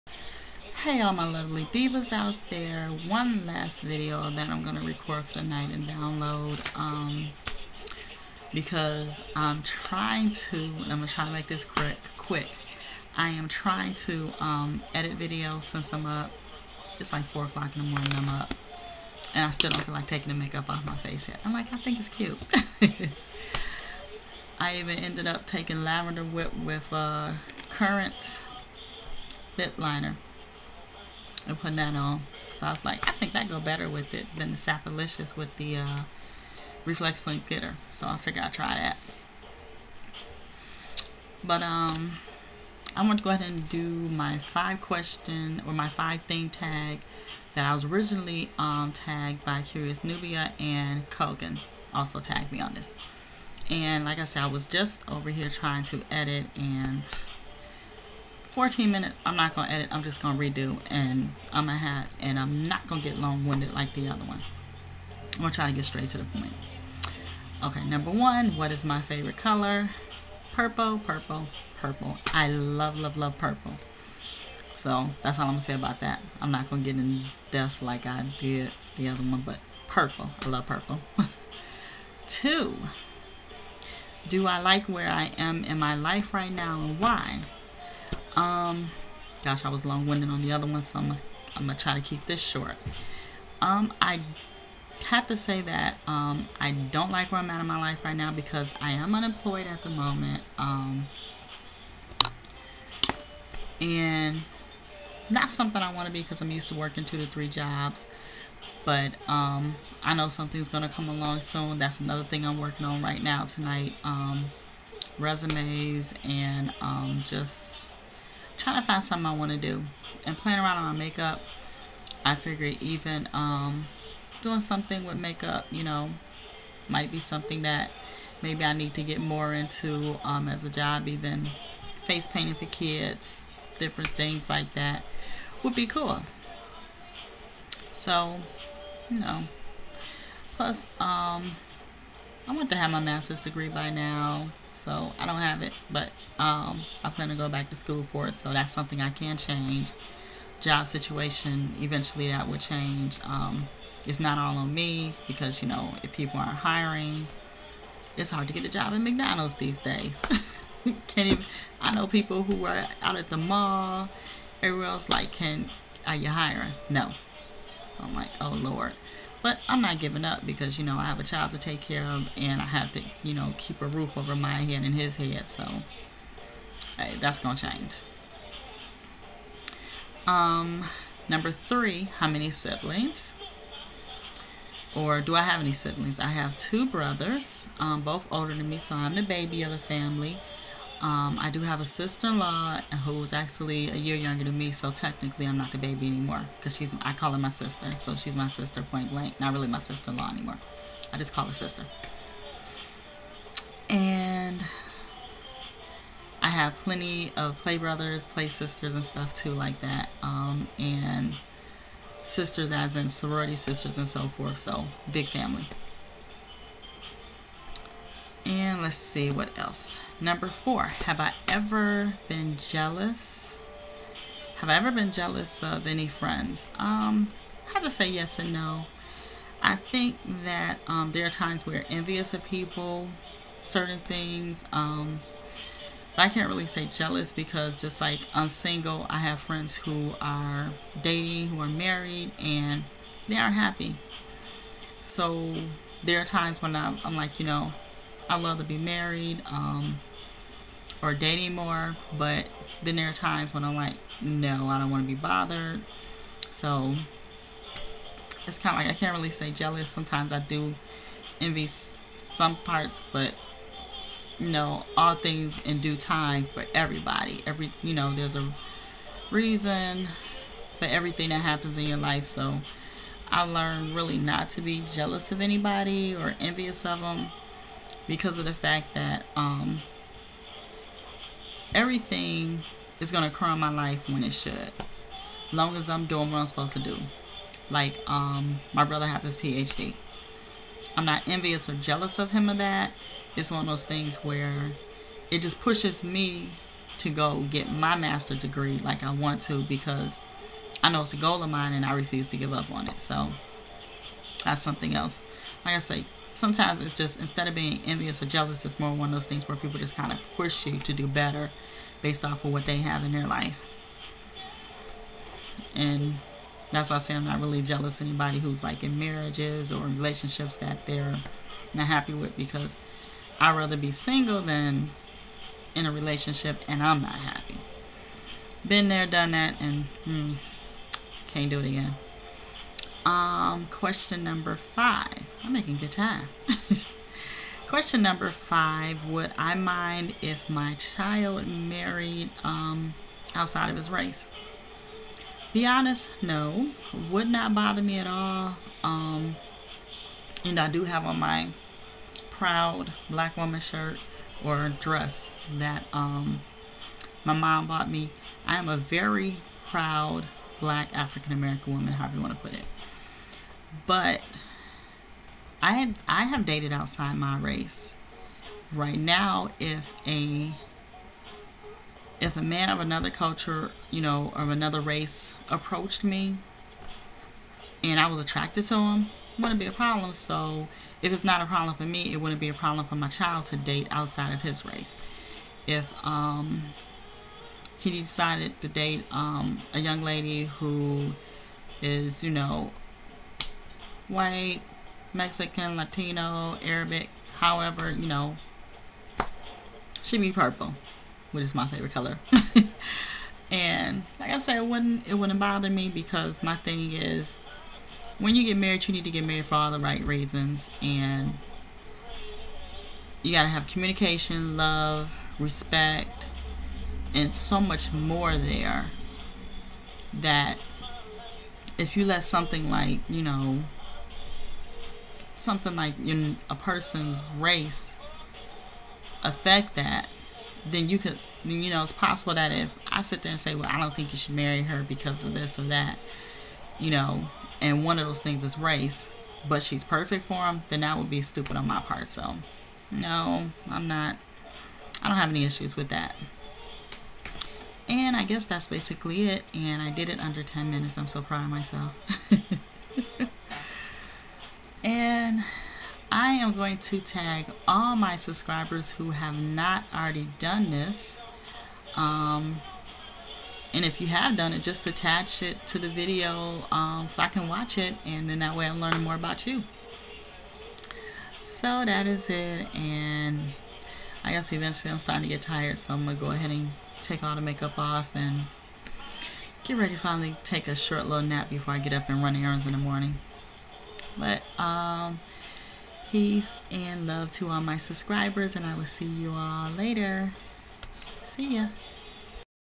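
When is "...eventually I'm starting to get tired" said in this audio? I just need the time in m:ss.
7:54.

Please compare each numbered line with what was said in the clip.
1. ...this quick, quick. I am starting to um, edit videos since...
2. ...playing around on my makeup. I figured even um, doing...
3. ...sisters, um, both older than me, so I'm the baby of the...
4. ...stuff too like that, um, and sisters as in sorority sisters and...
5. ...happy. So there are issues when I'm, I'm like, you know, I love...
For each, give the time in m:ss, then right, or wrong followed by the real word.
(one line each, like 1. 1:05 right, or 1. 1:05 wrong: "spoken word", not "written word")
1. 0:11 wrong: "trying", not "starting"
2. 2:00 right
3. 3:06 wrong: "brothers", not "sisters"
4. 3:29 right
5. 4:03 wrong: "times", not "issues".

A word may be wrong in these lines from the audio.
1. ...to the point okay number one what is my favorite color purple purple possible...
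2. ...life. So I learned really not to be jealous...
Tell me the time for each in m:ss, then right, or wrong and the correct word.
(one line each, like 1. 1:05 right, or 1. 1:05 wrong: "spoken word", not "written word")
1. 1:06 wrong: "purple", not "possible"
2. 4:31 right.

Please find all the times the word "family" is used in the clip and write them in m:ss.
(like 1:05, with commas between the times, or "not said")
3:09, 3:35.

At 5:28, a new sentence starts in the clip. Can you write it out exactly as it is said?
Been there, done that, and hmm, can't do it again.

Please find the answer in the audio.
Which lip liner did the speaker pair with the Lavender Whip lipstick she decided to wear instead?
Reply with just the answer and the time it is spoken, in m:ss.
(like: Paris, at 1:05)
Currant, at 0:27.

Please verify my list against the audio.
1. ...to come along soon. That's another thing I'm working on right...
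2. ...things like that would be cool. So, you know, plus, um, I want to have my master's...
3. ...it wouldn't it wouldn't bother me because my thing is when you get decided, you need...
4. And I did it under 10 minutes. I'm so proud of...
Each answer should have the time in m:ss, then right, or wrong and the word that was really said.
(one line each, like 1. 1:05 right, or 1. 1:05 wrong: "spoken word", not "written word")
1. 1:50 right
2. 2:14 right
3. 6:44 wrong: "married", not "decided"
4. 7:29 right.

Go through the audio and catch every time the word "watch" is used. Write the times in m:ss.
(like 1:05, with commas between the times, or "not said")
7:47.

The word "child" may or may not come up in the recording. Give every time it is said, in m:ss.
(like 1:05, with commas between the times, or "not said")
2:51, 5:40, 6:23.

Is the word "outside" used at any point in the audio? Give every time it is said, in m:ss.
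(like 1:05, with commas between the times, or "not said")
5:43, 6:06, 6:23.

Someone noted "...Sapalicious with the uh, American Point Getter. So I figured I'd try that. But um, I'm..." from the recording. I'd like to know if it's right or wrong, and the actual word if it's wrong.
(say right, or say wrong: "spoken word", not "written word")
wrong: "Reflex", not "American".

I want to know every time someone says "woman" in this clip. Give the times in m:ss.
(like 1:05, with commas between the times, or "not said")
5:53, 6:01.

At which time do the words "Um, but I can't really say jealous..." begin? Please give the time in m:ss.
3:54.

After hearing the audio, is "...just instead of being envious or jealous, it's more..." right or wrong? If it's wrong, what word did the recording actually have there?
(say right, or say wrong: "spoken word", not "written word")
right.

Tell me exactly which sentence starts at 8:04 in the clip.
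But um, Peace and love to all my subscribers, and I will see you all later.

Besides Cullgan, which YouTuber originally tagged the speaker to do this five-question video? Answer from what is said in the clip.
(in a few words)
Curious Nubia.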